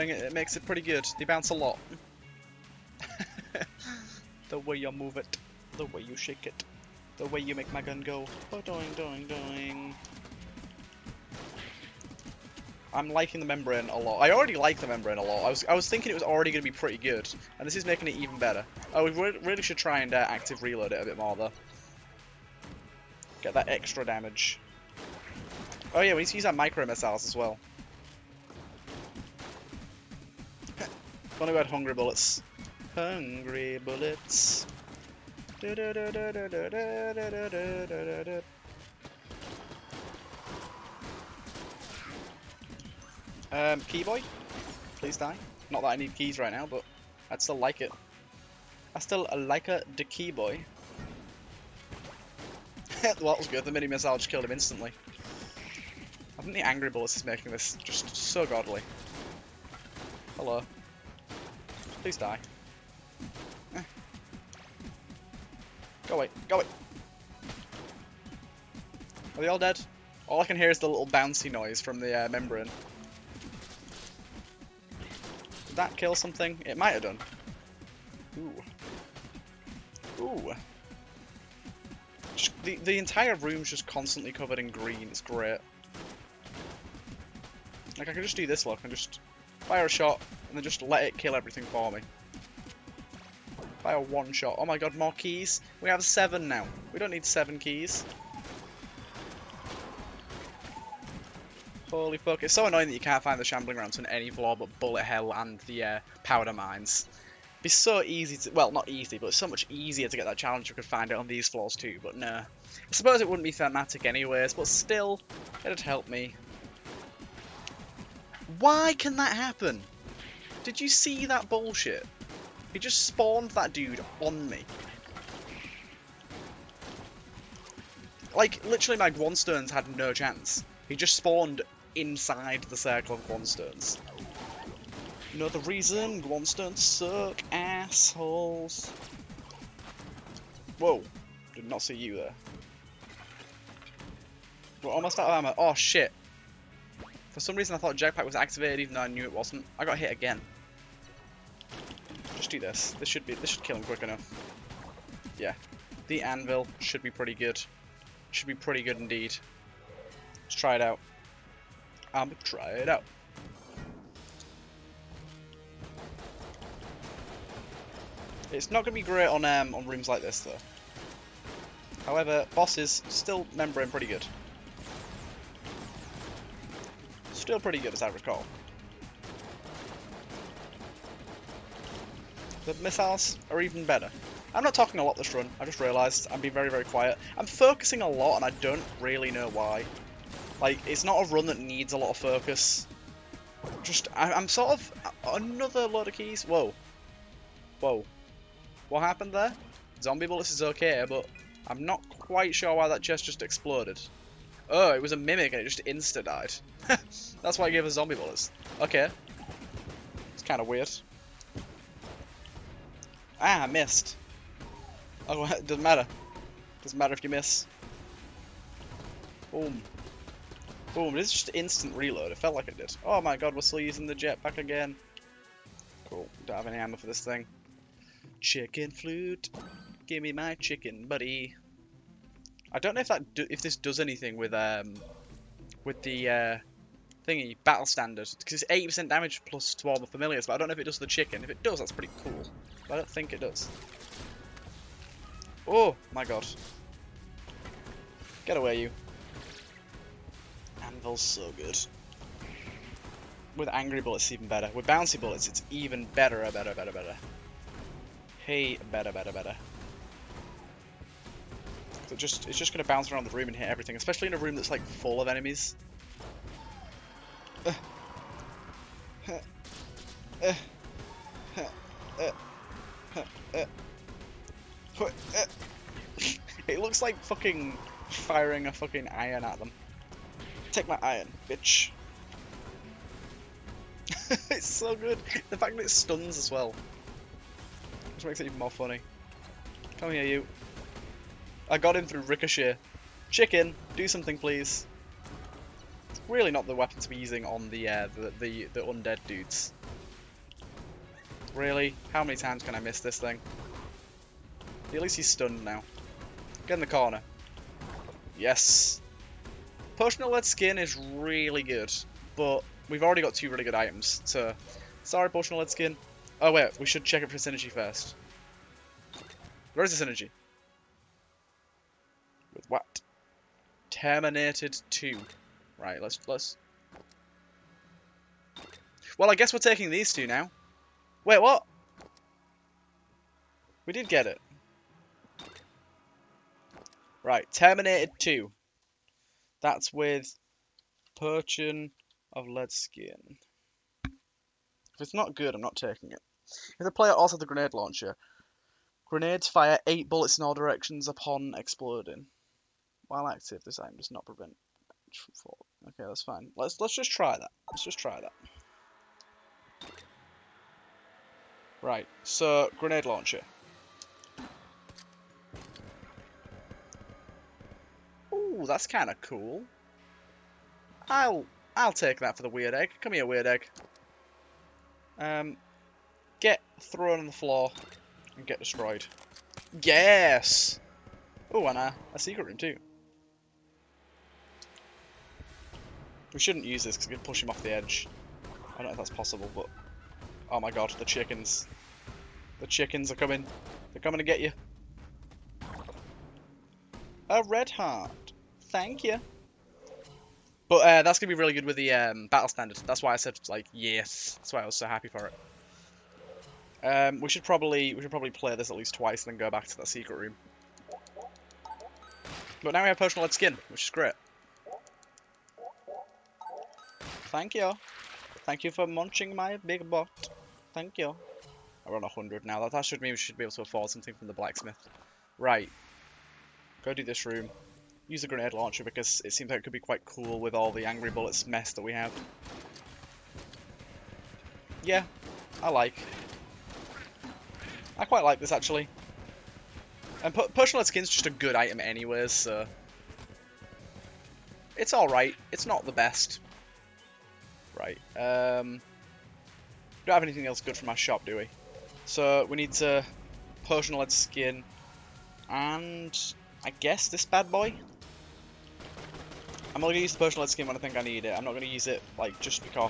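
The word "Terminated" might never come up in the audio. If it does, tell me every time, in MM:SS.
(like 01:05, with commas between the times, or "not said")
05:23, 05:37.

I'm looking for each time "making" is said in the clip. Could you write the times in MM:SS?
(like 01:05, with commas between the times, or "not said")
00:17, 00:57.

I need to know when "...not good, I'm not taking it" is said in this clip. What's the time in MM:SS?
05:45.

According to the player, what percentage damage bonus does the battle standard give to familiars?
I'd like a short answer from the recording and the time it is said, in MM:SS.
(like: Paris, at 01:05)
80%, at 03:58.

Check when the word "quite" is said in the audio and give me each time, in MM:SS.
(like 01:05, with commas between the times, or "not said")
03:22, 07:09, 07:18.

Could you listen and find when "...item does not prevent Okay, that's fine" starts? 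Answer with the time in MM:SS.
05:53.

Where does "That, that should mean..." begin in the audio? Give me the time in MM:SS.
07:02.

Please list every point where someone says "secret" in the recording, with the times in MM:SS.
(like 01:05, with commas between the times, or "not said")
06:22, 06:49.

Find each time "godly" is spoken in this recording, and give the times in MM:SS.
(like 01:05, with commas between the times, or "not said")
00:58.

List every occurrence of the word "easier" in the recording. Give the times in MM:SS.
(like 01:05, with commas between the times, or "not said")
01:49.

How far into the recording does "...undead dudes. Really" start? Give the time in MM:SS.
04:58.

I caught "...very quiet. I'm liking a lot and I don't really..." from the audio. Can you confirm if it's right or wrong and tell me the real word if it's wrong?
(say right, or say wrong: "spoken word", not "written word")
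wrong: "focusing", not "liking".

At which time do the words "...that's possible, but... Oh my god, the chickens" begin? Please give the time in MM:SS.
06:28.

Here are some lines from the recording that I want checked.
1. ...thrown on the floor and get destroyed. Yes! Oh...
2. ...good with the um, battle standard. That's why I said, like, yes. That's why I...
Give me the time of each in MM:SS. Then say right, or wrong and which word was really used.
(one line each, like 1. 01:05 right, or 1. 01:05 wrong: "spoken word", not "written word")
1. 06:16 right
2. 06:41 right.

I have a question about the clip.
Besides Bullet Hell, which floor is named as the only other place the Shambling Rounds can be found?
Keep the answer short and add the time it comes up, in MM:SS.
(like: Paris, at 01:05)
Powder Mines, at 01:46.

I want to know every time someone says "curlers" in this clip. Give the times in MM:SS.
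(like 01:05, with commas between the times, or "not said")
not said.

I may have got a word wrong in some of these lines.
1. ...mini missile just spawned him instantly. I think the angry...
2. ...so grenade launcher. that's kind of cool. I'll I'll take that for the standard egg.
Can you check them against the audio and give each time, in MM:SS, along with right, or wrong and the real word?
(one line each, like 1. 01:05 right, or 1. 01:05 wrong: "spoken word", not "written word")
1. 00:53 wrong: "killed", not "spawned"
2. 06:02 wrong: "weird", not "standard".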